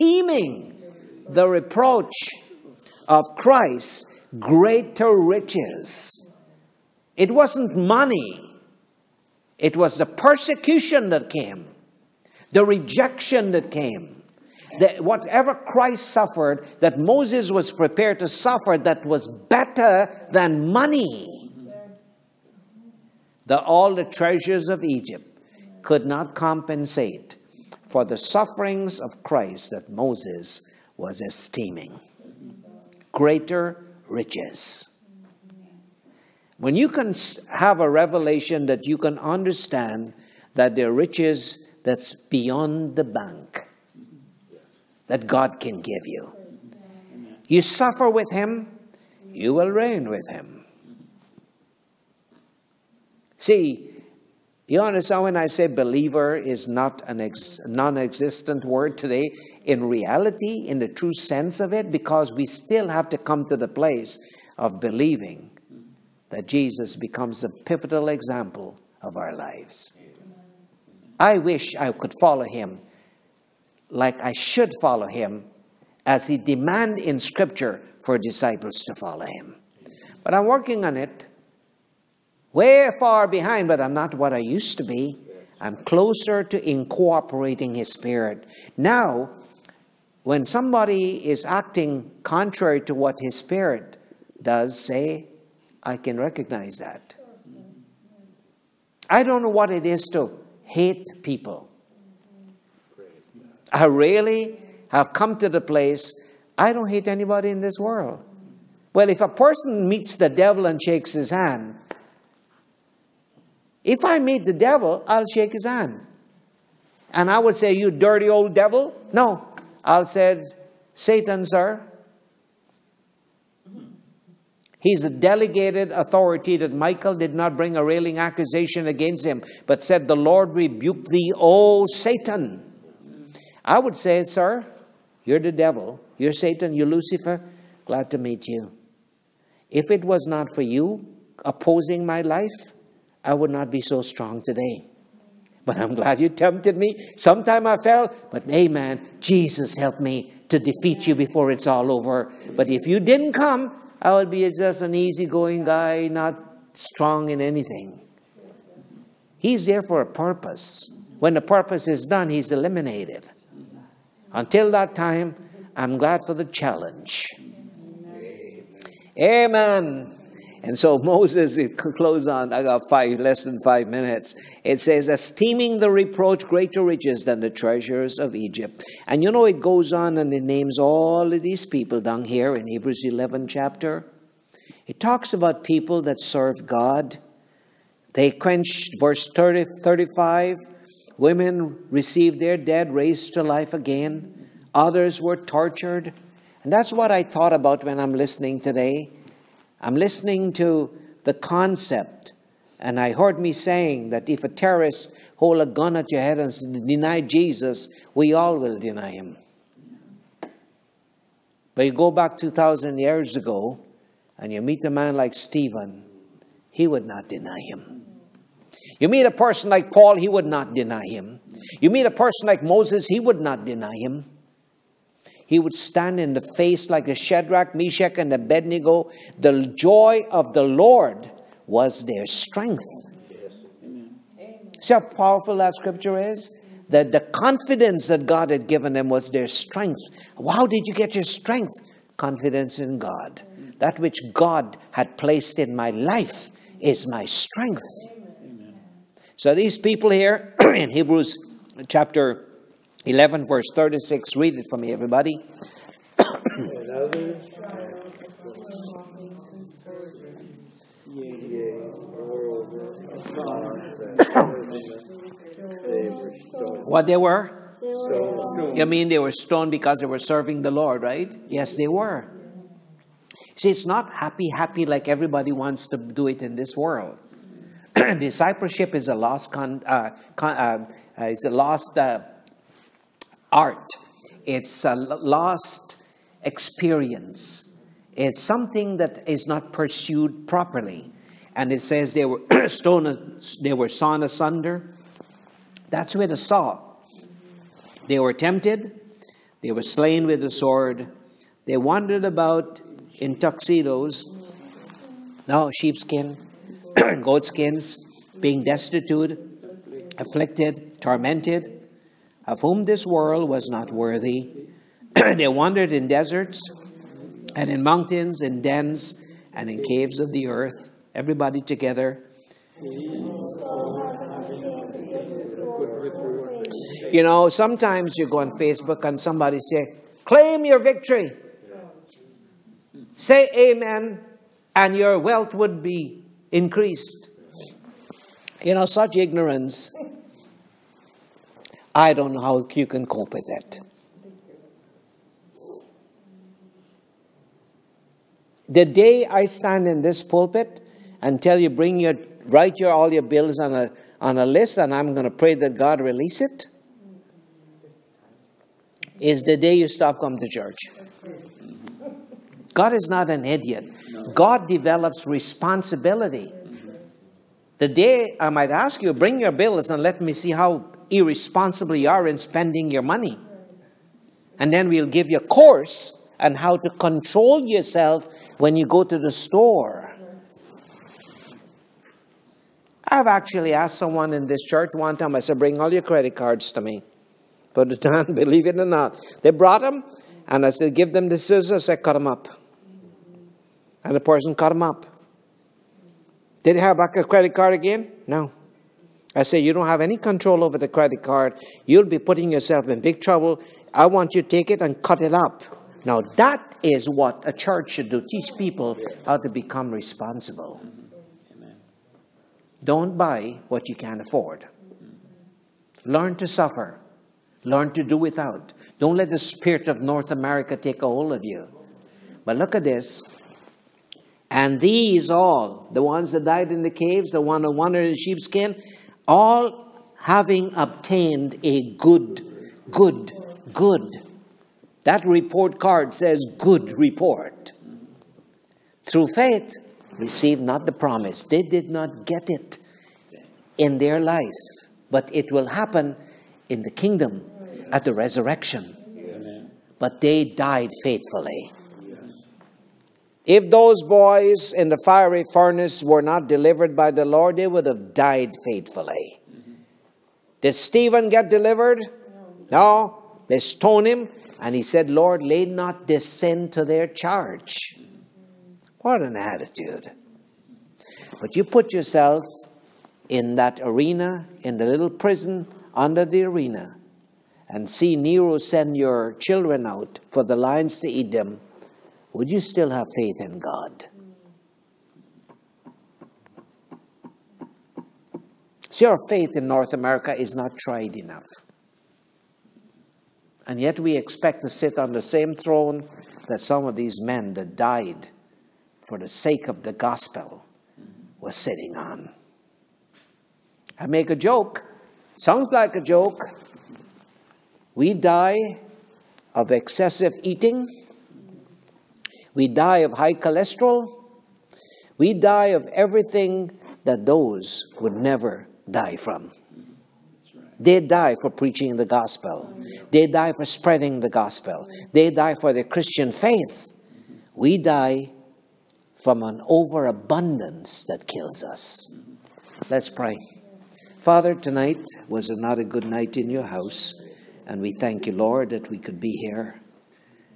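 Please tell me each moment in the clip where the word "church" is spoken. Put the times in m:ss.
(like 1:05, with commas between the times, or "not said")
6:00, 6:24, 6:47.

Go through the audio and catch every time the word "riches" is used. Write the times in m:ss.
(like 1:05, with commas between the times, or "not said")
0:05, 0:34, 0:40, 2:56.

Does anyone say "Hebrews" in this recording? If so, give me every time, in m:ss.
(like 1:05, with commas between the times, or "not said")
3:02, 4:10.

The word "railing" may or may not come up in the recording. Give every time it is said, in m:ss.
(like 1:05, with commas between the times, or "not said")
2:07.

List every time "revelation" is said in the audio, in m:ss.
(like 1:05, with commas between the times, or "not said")
0:37.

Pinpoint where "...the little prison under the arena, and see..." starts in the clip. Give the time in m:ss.
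7:54.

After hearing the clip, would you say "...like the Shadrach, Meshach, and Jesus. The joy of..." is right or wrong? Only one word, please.
wrong.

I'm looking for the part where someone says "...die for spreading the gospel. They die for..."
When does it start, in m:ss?
8:43.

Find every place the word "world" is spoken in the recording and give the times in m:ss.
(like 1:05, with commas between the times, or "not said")
1:47, 4:36, 5:13.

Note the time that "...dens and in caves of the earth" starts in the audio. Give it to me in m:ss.
5:18.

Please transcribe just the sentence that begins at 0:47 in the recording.
You suffer with Him, you will reign with Him.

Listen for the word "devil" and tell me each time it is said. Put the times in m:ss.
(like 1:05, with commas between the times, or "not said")
1:50, 1:54, 1:58, 2:15.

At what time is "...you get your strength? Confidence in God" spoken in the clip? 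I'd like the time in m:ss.
4:00.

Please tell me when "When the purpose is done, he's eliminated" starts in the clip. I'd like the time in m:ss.
2:41.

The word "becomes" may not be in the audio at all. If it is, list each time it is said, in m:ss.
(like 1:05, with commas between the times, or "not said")
1:06, 6:49.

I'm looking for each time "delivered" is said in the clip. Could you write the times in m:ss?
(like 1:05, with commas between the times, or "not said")
7:36, 7:41.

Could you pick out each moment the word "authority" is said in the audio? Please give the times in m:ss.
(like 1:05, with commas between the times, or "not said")
2:05.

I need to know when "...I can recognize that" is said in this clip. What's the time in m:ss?
1:35.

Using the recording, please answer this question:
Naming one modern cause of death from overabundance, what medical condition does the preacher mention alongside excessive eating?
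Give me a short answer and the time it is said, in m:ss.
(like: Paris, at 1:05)
high cholesterol, at 8:33.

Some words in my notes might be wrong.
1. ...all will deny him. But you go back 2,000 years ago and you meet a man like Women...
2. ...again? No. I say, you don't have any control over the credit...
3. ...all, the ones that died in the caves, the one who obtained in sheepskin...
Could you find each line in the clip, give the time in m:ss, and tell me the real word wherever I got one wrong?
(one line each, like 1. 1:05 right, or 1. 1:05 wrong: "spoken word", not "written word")
1. 3:28 wrong: "Stephen", not "Women"
2. 6:37 right
3. 7:05 wrong: "wandered", not "obtained".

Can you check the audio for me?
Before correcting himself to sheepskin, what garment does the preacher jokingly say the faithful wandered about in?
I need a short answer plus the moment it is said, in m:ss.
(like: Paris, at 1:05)
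tuxedos, at 5:03.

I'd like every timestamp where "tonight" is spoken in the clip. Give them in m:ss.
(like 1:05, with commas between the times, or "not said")
8:54.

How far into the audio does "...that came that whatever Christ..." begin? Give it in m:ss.
0:13.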